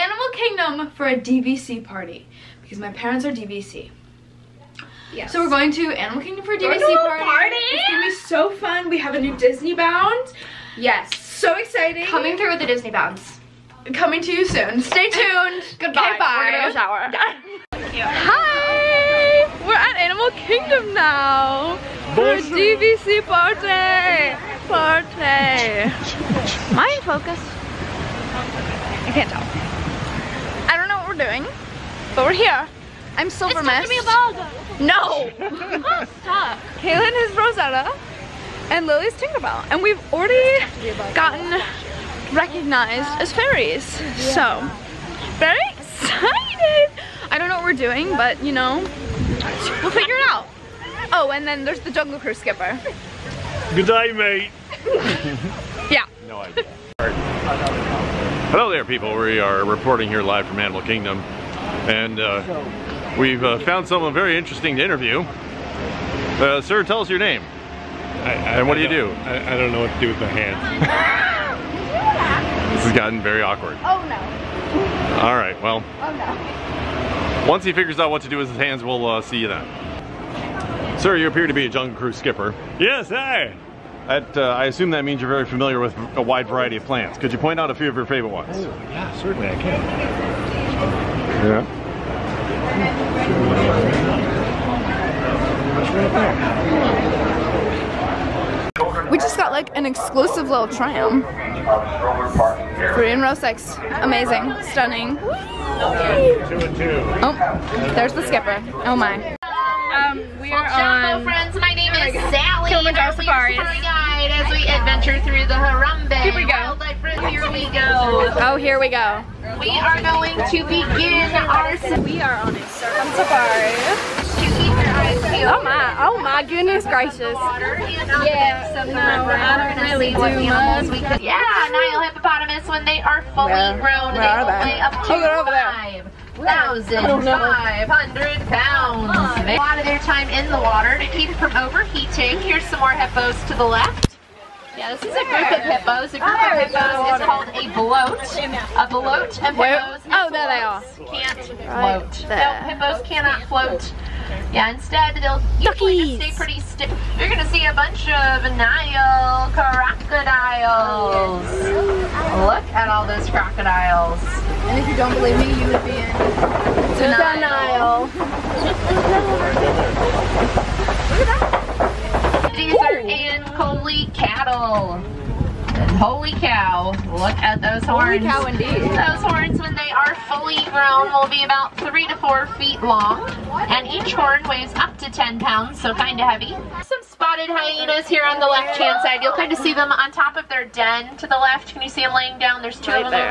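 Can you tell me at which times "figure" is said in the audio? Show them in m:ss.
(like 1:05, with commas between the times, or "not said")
0:49, 1:17.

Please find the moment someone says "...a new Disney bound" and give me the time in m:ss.
0:09.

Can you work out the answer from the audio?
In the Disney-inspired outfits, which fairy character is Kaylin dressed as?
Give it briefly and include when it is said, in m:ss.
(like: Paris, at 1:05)
Rosetta, at 0:36.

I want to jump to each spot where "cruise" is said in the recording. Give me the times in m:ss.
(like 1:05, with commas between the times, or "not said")
0:52, 1:21.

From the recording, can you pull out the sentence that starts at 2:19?
A lot of their time in the water to keep from overheating.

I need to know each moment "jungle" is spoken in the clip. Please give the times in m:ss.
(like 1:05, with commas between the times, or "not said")
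0:51, 1:21.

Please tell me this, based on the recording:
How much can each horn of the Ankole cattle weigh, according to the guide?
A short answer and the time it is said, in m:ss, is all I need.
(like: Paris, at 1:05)
10 pounds, at 3:05.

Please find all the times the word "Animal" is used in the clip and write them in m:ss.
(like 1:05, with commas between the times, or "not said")
0:05, 0:19, 1:00.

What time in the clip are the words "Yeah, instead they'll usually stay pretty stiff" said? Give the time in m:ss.
2:34.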